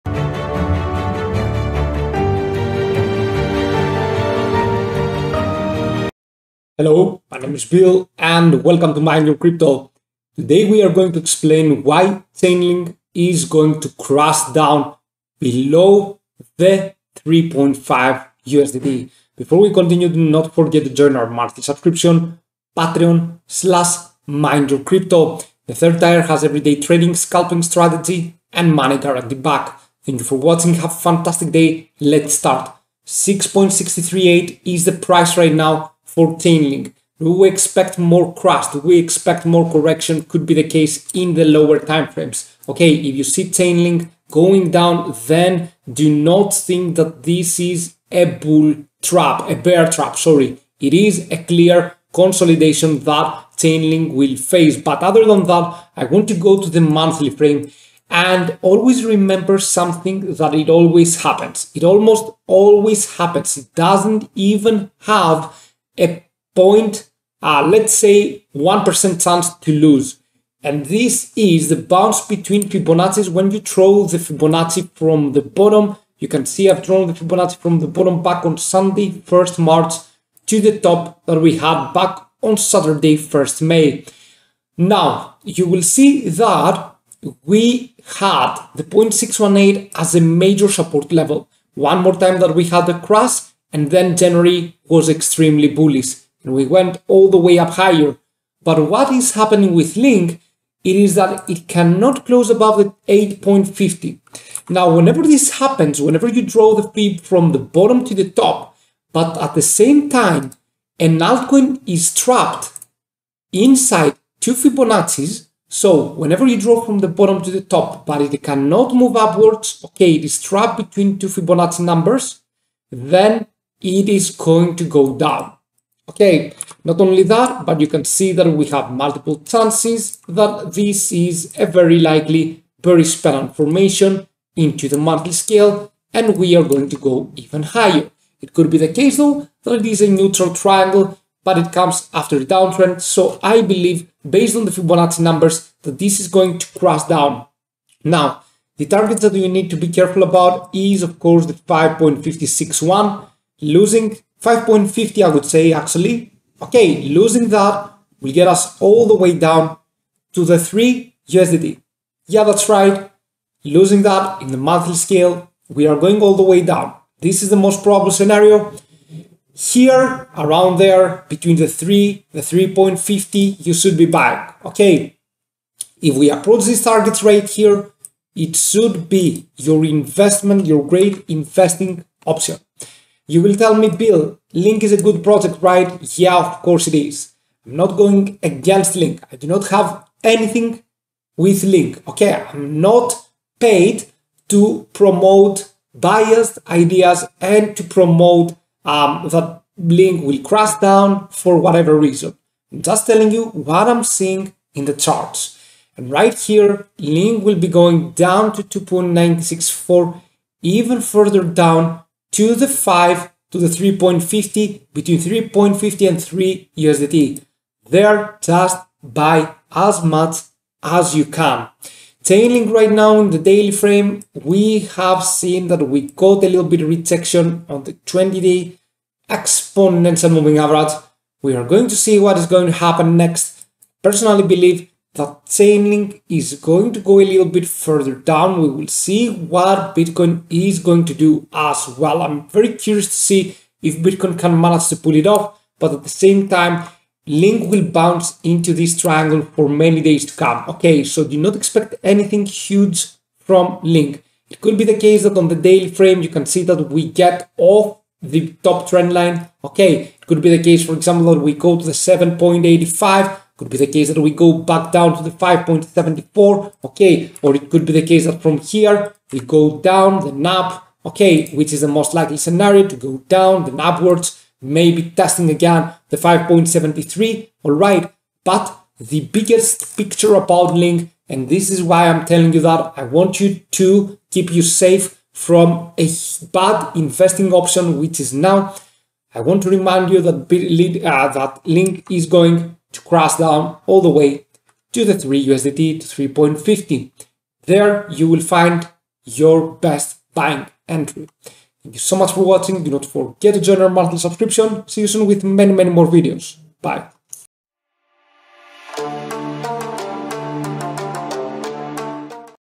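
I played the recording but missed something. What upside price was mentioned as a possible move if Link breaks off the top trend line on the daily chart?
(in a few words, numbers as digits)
7.85.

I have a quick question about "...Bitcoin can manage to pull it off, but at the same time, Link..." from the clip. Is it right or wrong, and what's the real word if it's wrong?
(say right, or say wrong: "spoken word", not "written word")
right.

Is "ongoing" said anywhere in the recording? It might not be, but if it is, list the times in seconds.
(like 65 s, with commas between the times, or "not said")
not said.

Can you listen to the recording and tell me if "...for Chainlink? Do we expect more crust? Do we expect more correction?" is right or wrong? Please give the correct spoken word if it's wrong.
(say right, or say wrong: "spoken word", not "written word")
right.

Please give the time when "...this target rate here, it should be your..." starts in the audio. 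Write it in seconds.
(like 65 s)
176 s.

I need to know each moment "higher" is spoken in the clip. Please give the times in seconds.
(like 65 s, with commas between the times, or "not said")
97 s, 137 s.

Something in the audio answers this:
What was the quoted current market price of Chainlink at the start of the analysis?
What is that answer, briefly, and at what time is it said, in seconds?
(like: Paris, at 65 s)
6.638, at 33 s.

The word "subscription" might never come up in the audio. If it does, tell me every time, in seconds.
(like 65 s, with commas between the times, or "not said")
21 s, 304 s.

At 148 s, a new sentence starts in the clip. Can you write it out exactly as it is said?
Now, the targets that you need to be careful about is of course the 5.561 losing 5.50, I would say actually.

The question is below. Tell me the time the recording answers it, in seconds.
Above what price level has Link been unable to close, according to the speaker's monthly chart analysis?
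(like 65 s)
103 s.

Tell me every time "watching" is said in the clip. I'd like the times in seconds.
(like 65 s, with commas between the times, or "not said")
30 s, 302 s.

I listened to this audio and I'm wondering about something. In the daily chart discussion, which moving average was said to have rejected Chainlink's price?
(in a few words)
20 day exponential moving average.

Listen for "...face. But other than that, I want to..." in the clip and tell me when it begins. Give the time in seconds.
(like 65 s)
54 s.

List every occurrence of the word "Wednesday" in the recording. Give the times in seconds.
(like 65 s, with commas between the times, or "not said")
not said.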